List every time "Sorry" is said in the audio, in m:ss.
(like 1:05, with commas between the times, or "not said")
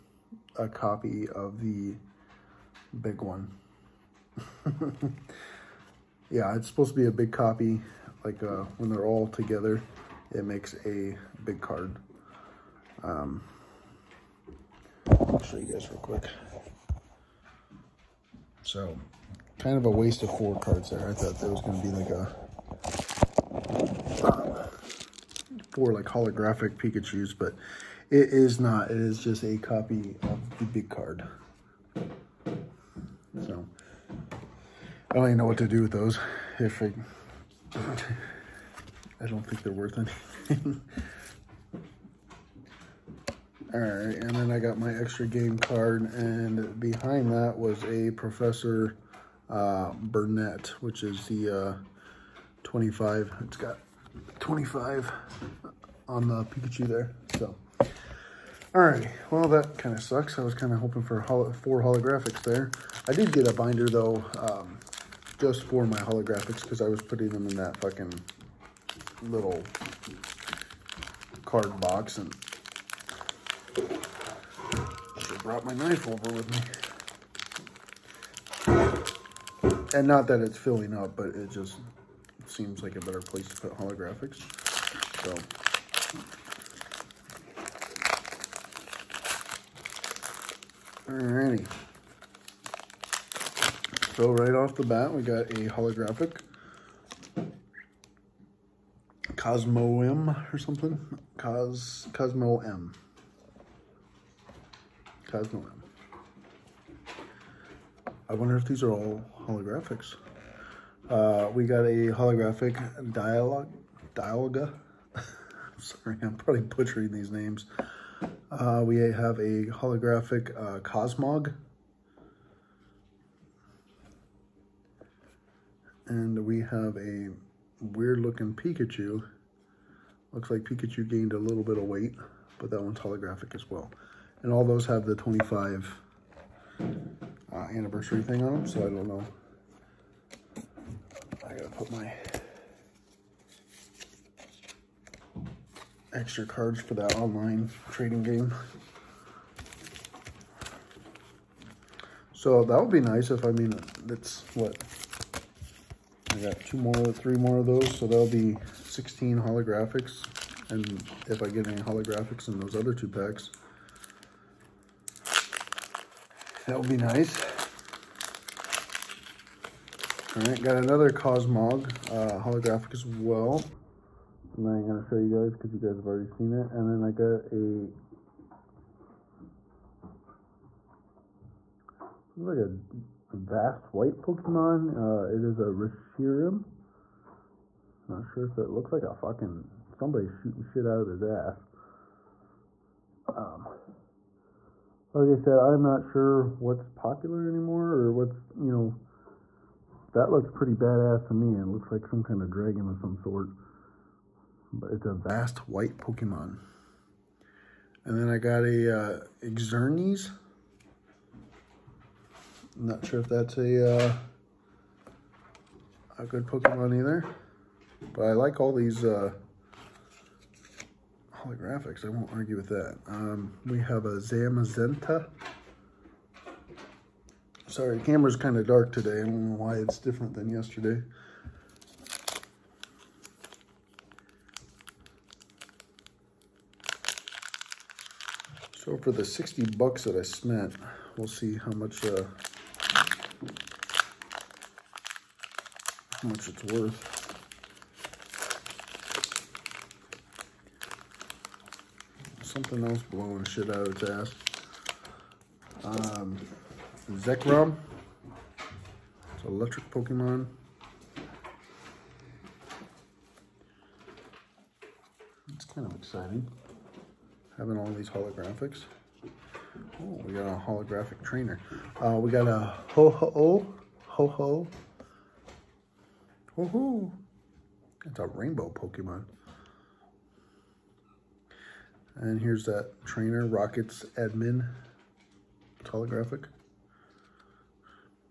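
1:55, 3:47.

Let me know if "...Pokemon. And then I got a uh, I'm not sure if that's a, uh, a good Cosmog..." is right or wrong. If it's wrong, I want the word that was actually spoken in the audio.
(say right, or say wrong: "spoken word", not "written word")
wrong: "Pokemon", not "Cosmog".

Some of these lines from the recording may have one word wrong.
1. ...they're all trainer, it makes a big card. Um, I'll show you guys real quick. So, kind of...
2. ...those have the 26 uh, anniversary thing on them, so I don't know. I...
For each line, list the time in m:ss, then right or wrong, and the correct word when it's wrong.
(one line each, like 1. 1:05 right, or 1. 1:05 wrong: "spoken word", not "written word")
1. 0:08 wrong: "together", not "trainer"
2. 2:14 wrong: "25", not "26".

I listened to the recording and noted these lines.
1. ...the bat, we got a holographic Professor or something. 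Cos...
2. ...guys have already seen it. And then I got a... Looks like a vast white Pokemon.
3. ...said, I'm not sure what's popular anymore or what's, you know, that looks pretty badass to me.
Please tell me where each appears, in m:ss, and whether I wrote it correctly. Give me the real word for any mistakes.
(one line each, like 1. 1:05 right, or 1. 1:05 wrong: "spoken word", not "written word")
1. 1:34 wrong: "Cosmoem", not "Professor"
2. 2:55 right
3. 3:15 right.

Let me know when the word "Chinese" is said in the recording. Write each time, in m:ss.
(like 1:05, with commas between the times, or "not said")
not said.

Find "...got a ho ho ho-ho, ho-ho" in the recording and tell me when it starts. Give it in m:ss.
4:32.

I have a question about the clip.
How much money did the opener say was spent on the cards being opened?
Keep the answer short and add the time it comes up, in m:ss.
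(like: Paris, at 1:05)
$60, at 3:59.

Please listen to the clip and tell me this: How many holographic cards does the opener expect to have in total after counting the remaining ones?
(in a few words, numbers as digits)
16.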